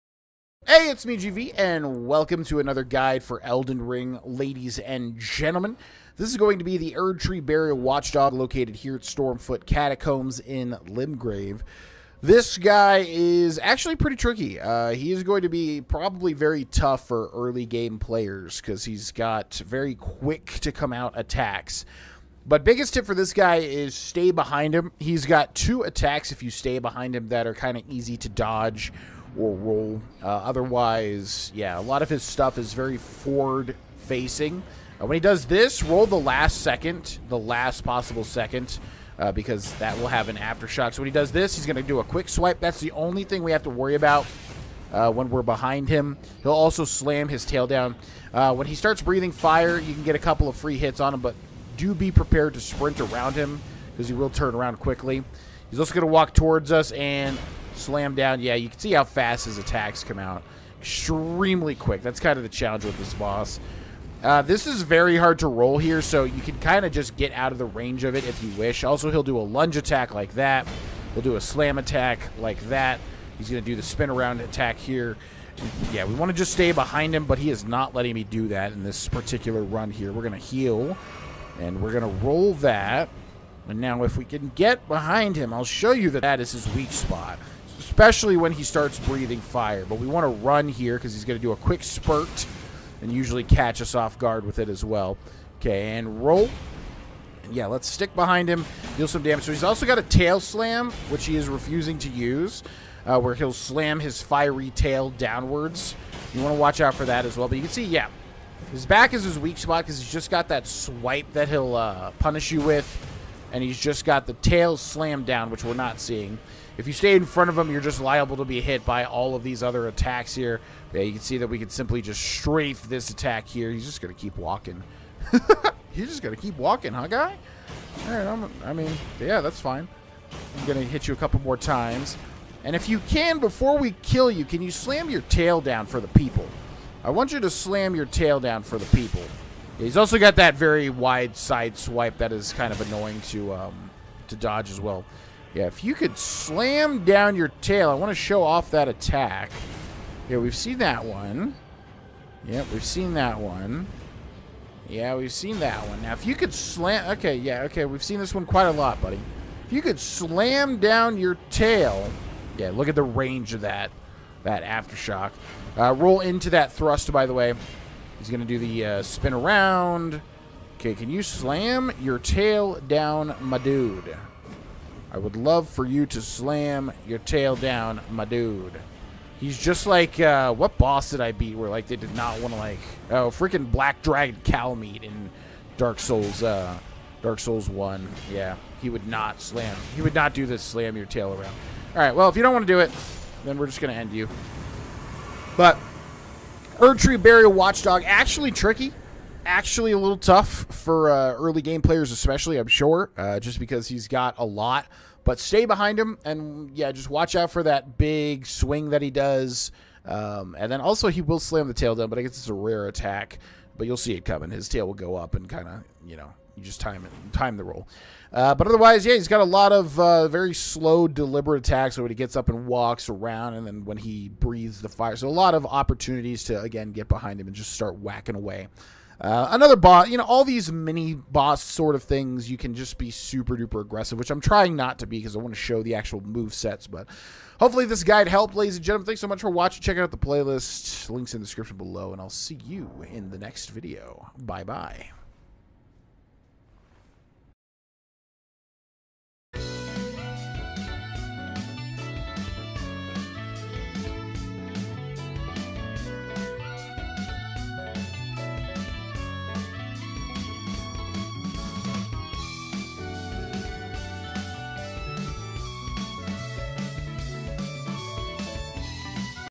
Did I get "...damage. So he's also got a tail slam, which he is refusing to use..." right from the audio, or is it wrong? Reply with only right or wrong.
right.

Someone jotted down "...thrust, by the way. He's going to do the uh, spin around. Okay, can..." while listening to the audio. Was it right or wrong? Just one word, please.
right.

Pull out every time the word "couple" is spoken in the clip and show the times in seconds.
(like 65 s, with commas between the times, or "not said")
50 s, 131 s.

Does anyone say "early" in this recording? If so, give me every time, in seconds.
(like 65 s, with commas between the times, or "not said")
17 s, 201 s.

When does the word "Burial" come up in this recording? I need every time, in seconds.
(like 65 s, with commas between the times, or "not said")
7 s, 197 s.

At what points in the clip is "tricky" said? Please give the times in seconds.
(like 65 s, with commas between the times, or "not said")
14 s, 198 s.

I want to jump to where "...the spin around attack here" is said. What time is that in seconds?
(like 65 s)
73 s.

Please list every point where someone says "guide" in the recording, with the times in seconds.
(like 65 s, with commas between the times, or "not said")
2 s, 238 s.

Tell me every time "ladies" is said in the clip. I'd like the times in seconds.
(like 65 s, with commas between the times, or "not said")
4 s, 238 s.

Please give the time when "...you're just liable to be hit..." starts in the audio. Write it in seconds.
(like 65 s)
117 s.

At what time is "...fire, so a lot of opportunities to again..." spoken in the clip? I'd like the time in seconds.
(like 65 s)
224 s.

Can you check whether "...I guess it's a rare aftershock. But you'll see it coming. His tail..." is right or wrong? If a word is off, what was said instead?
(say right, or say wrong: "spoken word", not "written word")
wrong: "attack", not "aftershock".